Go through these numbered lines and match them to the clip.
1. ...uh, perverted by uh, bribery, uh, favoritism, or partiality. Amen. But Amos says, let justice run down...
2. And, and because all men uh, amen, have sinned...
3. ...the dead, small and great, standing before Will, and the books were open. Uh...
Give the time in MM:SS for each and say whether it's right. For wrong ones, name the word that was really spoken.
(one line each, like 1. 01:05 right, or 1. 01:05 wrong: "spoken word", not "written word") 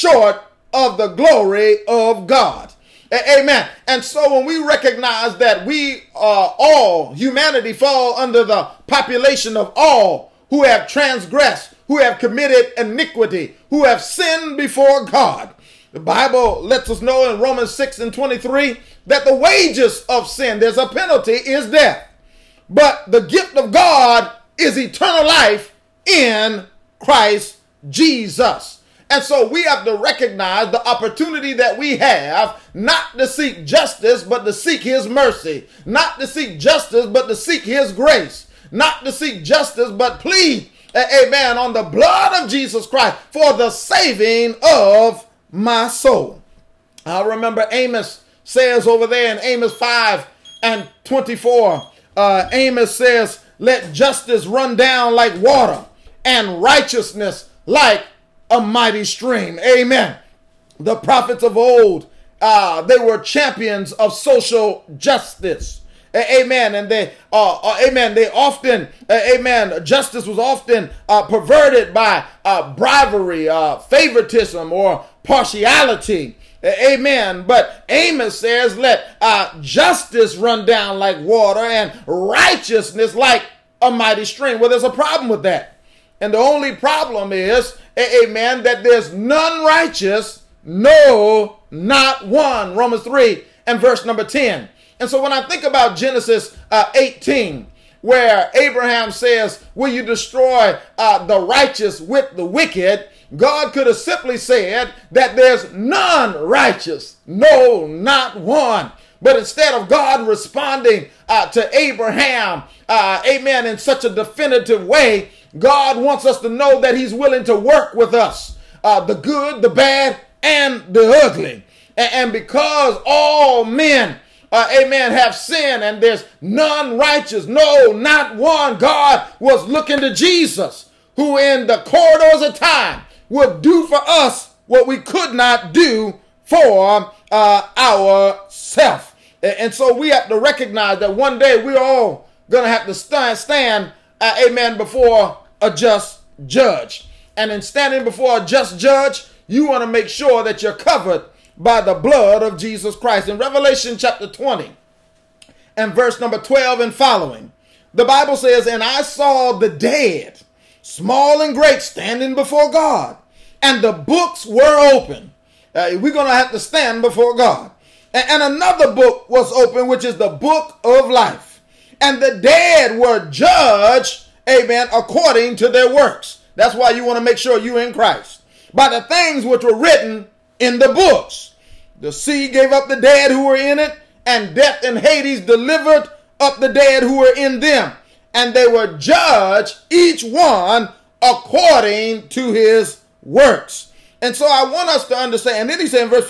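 1. 01:11 right
2. 02:01 right
3. 02:39 wrong: "God", not "Will".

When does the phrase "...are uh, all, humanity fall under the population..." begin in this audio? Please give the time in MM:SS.
00:06.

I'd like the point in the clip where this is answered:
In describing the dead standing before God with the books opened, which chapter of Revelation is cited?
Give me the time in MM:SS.
02:33.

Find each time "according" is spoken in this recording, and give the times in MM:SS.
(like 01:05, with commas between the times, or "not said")
02:54, 03:11.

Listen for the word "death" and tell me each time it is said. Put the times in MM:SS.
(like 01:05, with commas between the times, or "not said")
00:21, 03:04.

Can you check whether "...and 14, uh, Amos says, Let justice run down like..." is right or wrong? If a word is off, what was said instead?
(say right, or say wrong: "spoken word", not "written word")
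wrong: "24", not "14".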